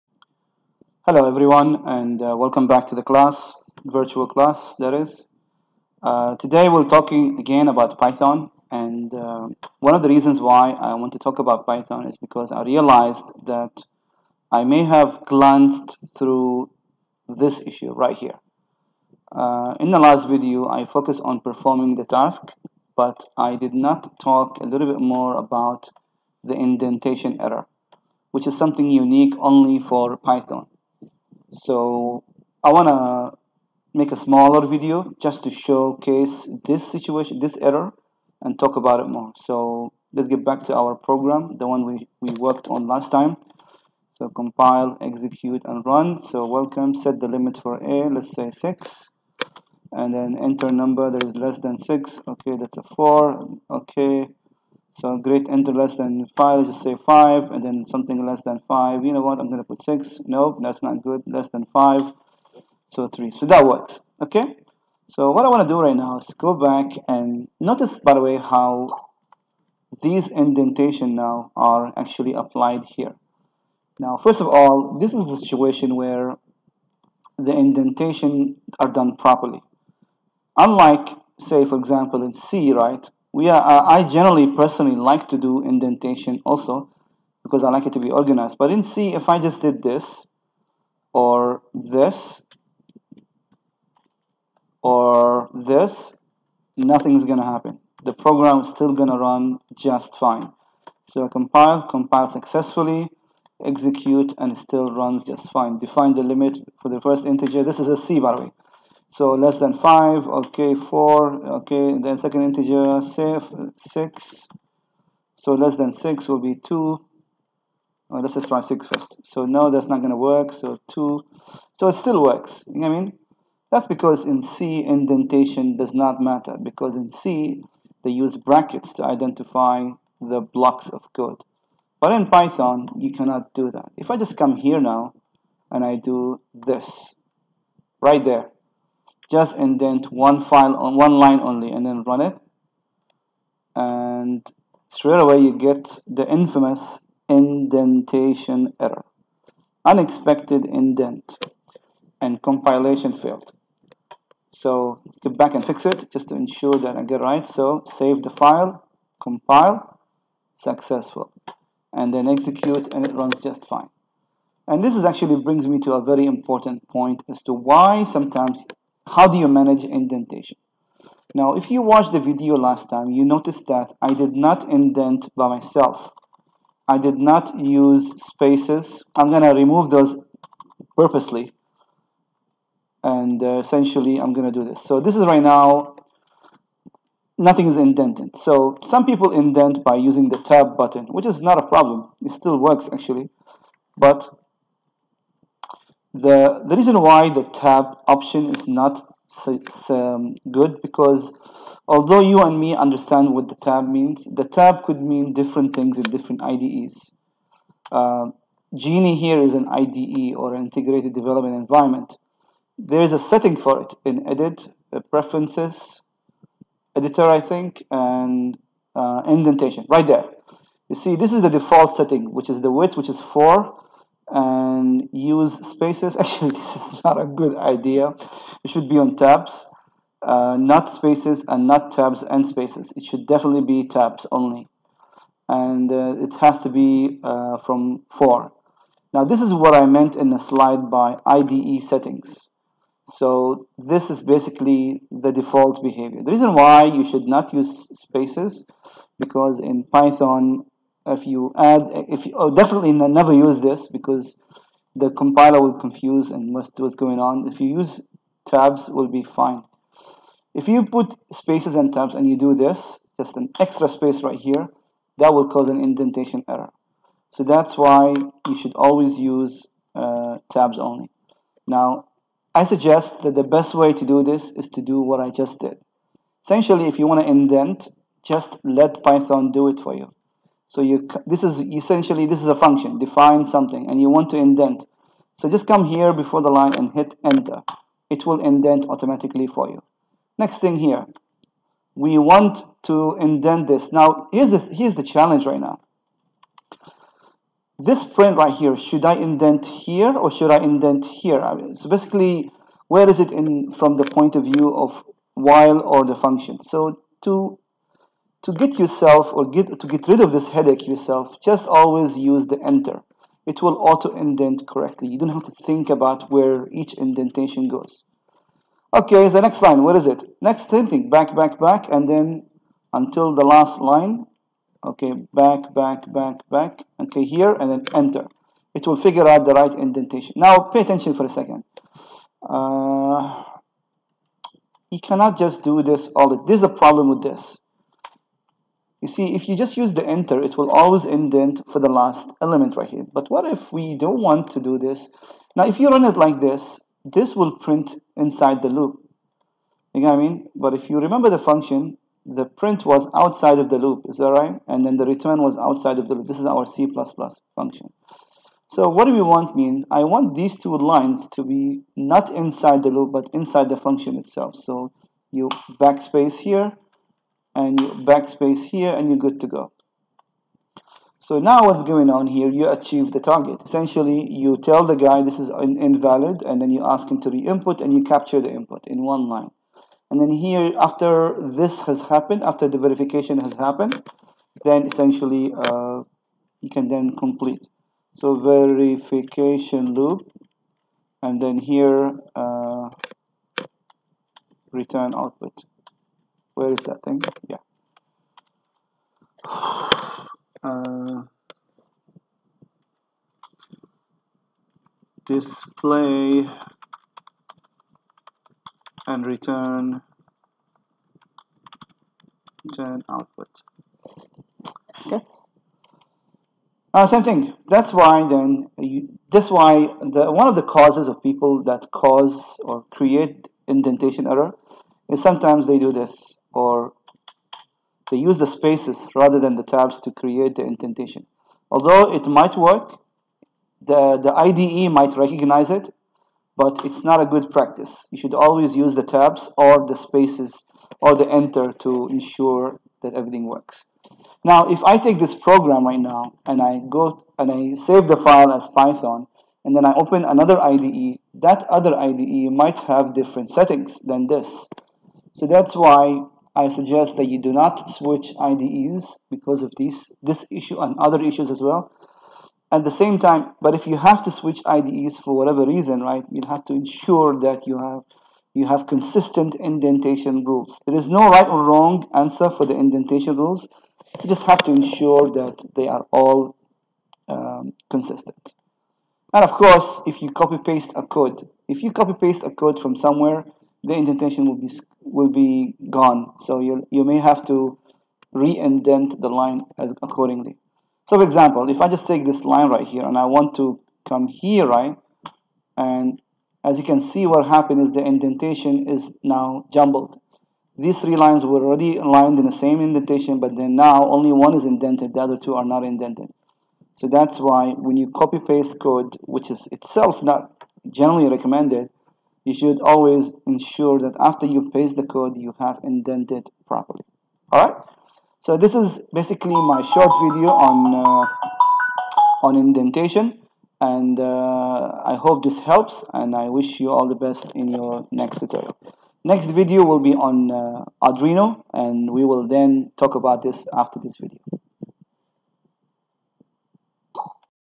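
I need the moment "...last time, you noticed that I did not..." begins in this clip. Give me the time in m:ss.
2:52.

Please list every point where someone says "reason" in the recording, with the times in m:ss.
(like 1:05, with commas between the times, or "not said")
0:10, 3:16, 4:06, 7:45.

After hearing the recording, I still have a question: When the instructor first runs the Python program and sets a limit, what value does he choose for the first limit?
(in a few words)
6.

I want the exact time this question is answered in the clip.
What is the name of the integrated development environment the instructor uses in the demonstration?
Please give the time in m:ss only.
3:28.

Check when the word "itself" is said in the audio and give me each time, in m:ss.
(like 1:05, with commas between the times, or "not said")
6:04, 8:29.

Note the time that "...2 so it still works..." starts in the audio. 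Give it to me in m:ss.
2:00.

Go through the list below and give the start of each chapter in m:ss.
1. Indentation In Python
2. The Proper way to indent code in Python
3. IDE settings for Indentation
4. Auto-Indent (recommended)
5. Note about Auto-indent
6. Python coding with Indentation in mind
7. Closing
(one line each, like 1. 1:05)
1. 0:39
2. 2:44
3. 3:27
4. 4:32
5. 5:37
6. 6:10
7. 8:38.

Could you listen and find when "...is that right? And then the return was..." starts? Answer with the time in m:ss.
5:54.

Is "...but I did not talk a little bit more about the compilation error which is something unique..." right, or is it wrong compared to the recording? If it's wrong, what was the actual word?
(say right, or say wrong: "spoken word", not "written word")
wrong: "indentation", not "compilation".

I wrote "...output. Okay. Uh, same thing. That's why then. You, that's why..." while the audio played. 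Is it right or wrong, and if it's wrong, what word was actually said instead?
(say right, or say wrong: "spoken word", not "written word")
right.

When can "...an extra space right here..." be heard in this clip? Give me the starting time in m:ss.
4:23.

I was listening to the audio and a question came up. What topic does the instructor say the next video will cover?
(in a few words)
Arduino.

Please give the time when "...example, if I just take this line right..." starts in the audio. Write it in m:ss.
8:11.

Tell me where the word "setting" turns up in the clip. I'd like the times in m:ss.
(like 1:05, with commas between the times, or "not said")
3:33, 3:41, 4:01, 7:33.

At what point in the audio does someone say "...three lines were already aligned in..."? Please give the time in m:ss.
8:20.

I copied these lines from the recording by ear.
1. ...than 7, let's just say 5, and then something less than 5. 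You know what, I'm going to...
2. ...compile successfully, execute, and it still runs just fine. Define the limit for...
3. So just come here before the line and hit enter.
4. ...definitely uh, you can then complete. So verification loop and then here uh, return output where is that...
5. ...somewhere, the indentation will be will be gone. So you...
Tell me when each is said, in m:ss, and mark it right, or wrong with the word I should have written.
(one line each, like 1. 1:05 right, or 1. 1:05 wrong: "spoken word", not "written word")
1. 0:55 wrong: "5", not "7"
2. 1:41 right
3. 4:45 right
4. 6:24 wrong: "essentially", not "definitely"
5. 8:02 right.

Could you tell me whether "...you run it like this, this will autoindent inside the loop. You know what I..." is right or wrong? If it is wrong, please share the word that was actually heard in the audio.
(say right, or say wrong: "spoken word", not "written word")
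wrong: "print", not "autoindent".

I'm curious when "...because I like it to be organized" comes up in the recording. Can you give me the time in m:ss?
1:27.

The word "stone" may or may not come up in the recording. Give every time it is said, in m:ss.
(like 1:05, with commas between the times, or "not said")
not said.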